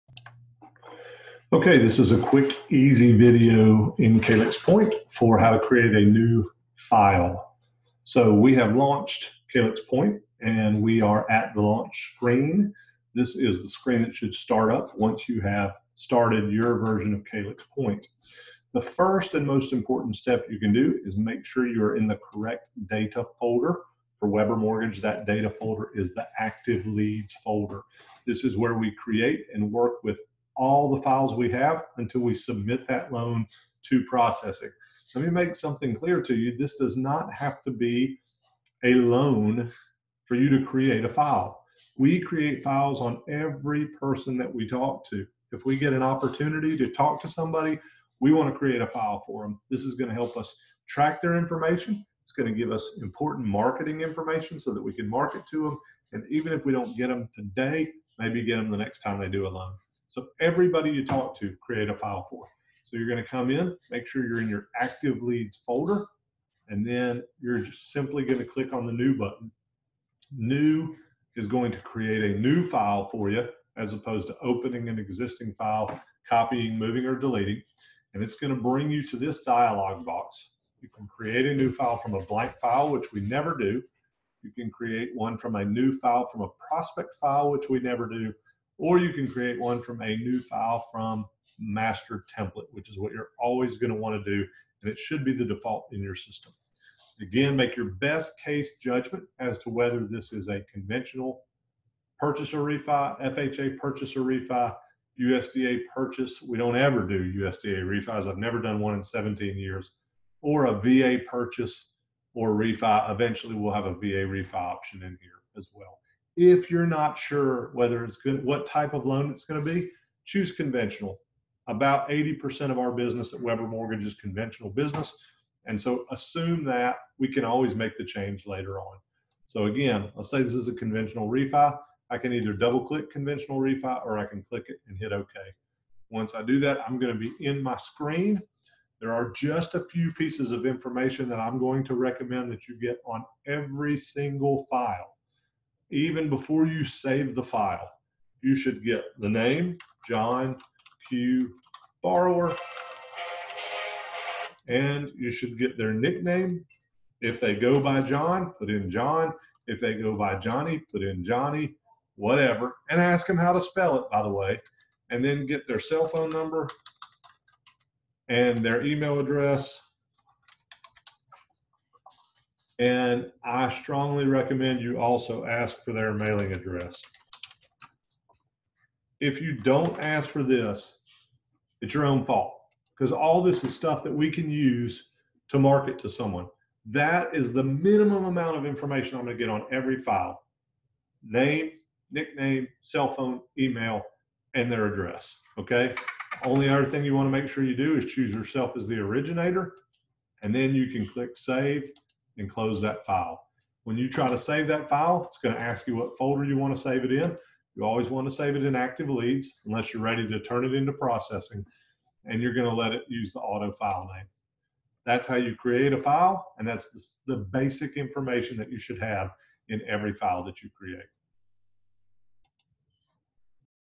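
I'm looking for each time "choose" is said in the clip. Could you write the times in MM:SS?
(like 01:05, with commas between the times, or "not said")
02:00, 03:18.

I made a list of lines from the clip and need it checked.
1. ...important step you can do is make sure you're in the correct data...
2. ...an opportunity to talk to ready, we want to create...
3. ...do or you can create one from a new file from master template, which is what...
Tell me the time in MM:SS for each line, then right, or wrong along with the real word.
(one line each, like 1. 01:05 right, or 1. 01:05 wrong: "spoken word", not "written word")
1. 00:19 right
2. 00:45 wrong: "somebody", not "ready"
3. 01:28 right.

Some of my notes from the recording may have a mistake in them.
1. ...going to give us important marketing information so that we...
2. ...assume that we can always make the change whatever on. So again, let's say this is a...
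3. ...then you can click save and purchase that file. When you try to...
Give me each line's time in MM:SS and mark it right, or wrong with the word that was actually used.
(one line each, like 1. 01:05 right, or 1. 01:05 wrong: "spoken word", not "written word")
1. 00:52 right
2. 02:06 wrong: "later", not "whatever"
3. 03:20 wrong: "close", not "purchase".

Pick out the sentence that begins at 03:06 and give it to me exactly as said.
That is the minimum amount of information I'm going to get on every file name, nickname, cell phone, email, and their address.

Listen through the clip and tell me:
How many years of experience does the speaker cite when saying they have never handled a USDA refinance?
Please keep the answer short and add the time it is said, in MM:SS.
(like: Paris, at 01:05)
17, at 01:49.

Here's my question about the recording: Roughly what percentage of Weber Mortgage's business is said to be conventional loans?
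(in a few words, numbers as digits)
80%.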